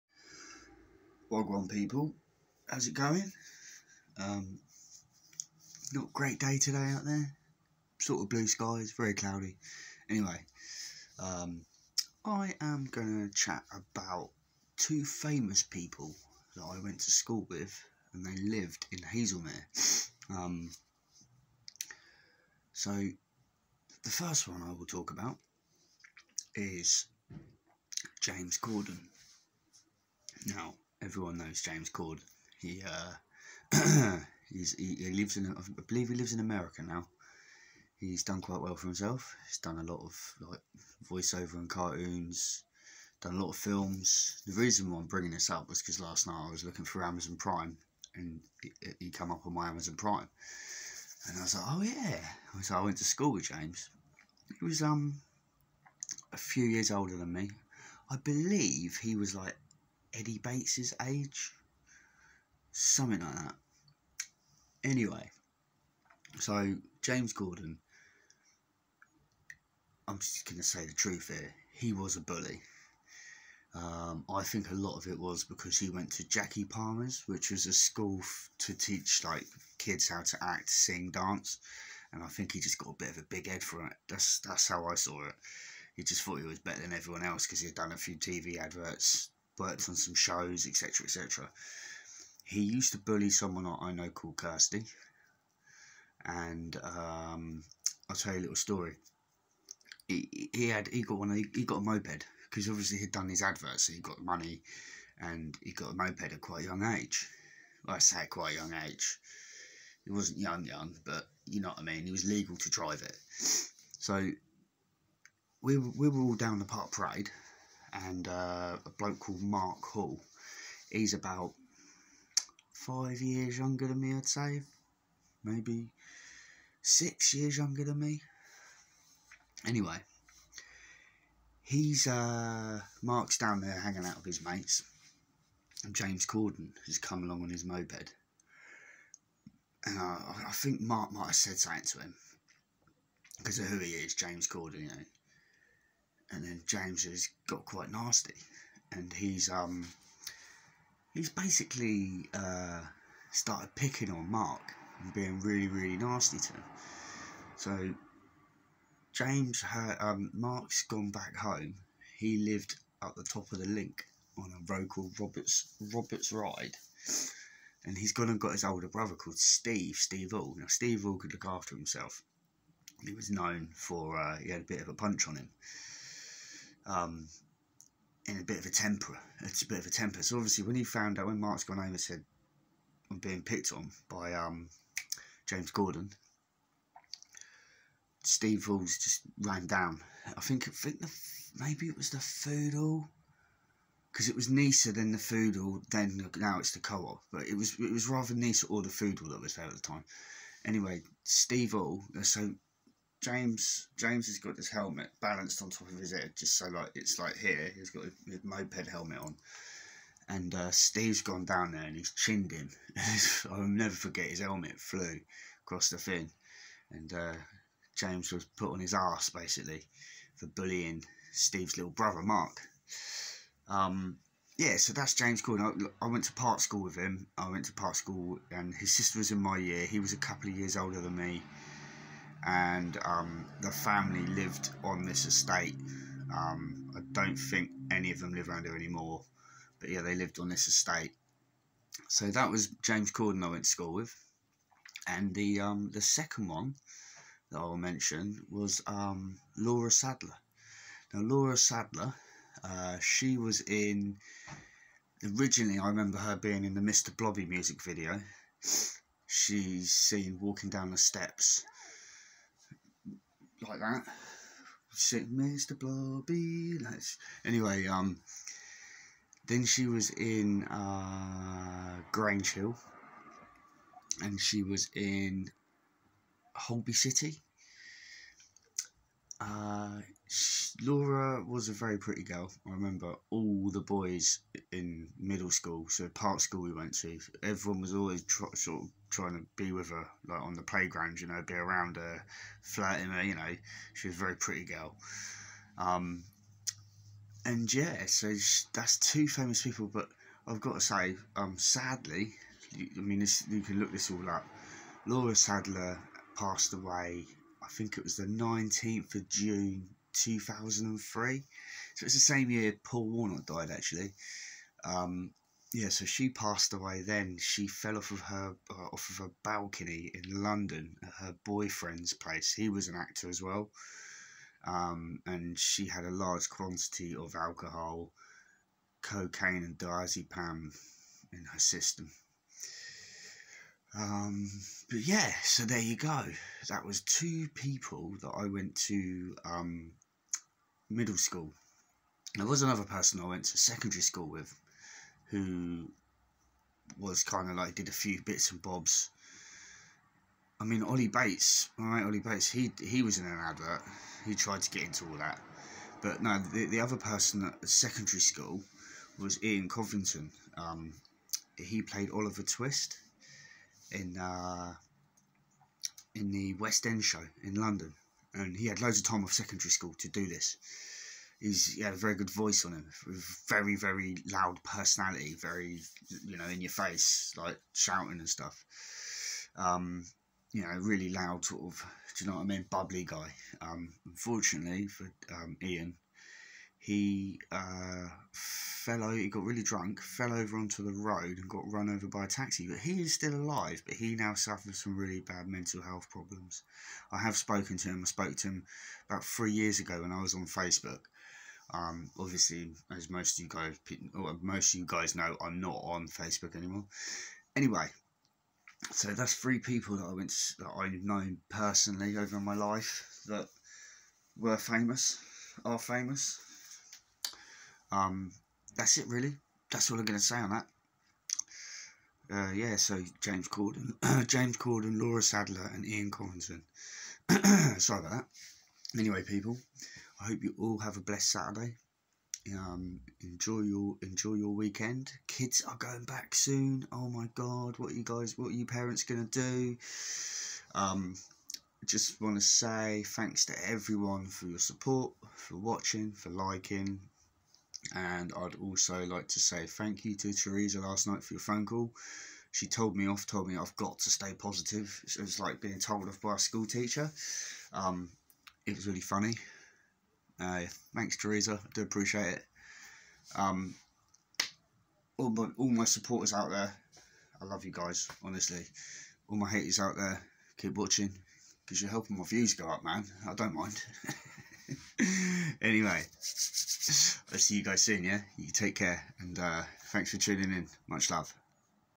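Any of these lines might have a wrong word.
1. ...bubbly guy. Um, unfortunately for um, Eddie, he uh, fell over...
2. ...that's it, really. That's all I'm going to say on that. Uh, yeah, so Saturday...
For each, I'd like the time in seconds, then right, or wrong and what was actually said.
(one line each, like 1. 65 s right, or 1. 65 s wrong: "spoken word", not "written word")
1. 382 s wrong: "Ian", not "Eddie"
2. 418 s wrong: "James", not "Saturday".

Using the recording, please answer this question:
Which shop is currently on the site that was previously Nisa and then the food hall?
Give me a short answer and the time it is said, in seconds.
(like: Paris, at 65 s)
The Co-op, at 196 s.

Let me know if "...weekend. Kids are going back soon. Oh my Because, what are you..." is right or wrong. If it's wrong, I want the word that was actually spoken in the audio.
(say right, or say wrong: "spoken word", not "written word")
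wrong: "God", not "Because".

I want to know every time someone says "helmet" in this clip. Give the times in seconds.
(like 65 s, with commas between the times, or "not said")
204 s, 208 s, 214 s.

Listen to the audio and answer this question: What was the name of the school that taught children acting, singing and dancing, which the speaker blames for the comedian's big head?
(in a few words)
Jackie Palmer's.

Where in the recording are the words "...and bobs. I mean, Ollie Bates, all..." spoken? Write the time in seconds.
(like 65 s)
348 s.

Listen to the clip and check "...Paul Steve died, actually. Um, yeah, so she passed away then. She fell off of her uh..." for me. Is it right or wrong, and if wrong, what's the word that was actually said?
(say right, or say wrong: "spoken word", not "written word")
wrong: "Warnock", not "Steve".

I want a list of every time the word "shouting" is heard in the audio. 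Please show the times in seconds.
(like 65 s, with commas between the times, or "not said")
377 s.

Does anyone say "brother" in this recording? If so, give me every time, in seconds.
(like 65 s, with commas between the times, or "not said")
168 s, 221 s.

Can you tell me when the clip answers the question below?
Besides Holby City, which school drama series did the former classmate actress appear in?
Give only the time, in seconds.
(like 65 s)
272 s.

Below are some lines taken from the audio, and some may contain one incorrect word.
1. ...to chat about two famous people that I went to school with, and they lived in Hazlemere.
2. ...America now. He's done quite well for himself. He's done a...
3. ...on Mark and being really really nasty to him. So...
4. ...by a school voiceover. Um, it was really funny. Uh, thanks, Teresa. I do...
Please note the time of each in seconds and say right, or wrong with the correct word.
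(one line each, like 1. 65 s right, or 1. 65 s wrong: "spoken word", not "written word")
1. 13 s right
2. 36 s right
3. 154 s right
4. 456 s wrong: "teacher", not "voiceover".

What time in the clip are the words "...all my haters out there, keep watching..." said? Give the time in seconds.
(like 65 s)
469 s.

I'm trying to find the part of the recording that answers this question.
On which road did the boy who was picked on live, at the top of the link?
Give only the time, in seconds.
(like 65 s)
165 s.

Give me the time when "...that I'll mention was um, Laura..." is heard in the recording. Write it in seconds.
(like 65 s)
247 s.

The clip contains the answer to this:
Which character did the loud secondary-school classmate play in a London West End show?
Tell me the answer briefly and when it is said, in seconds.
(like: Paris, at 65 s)
Oliver Twist, at 362 s.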